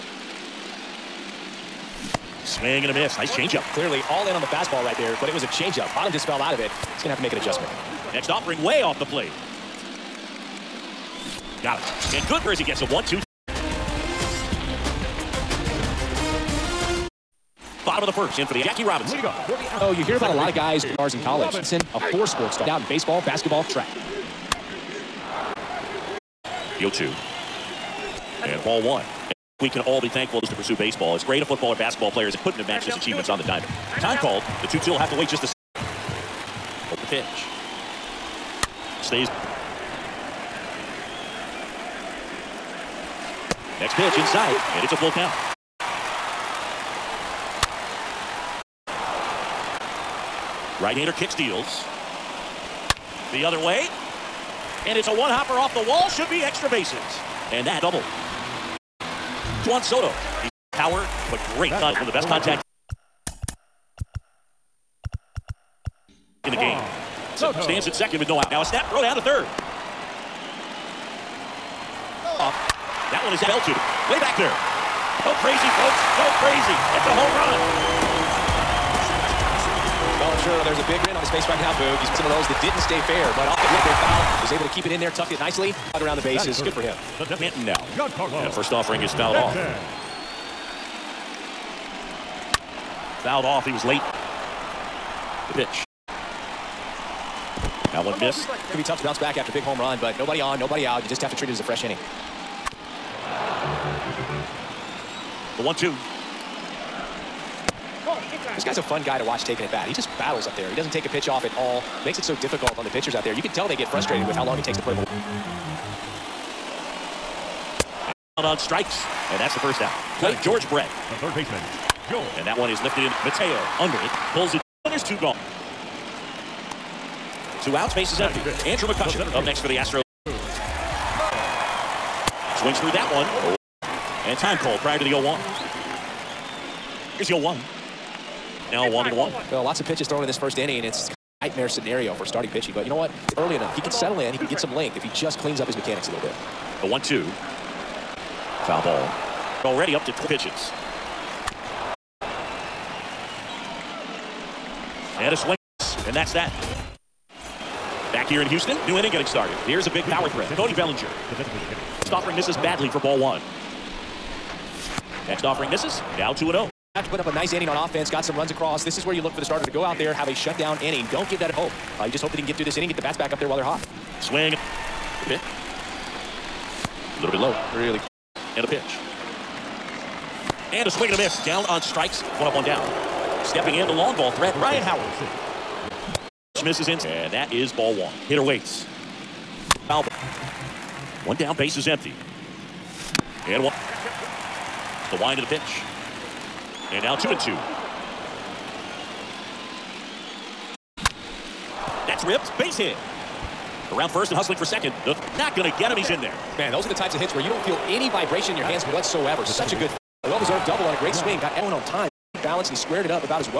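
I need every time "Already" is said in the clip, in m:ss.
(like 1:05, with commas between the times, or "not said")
2:29.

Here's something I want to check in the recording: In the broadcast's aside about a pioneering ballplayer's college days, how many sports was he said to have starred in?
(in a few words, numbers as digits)
4.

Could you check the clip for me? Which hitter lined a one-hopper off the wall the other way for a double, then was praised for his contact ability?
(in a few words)
Juan Soto.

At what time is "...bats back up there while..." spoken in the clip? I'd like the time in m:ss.
2:53.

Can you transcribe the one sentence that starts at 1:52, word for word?
Makes it so difficult on the pitchers out there.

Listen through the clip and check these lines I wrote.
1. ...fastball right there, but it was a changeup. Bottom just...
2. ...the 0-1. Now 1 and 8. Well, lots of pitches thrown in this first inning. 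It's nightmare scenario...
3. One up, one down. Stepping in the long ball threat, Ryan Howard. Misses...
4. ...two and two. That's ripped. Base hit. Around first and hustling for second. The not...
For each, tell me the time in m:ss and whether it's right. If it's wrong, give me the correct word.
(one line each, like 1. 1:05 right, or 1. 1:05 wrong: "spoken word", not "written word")
1. 0:04 right
2. 2:17 wrong: "1", not "8"
3. 3:02 right
4. 3:17 right.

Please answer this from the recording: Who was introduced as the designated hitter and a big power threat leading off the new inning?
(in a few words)
Cody Bellinger.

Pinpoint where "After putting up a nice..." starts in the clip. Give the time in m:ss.
2:46.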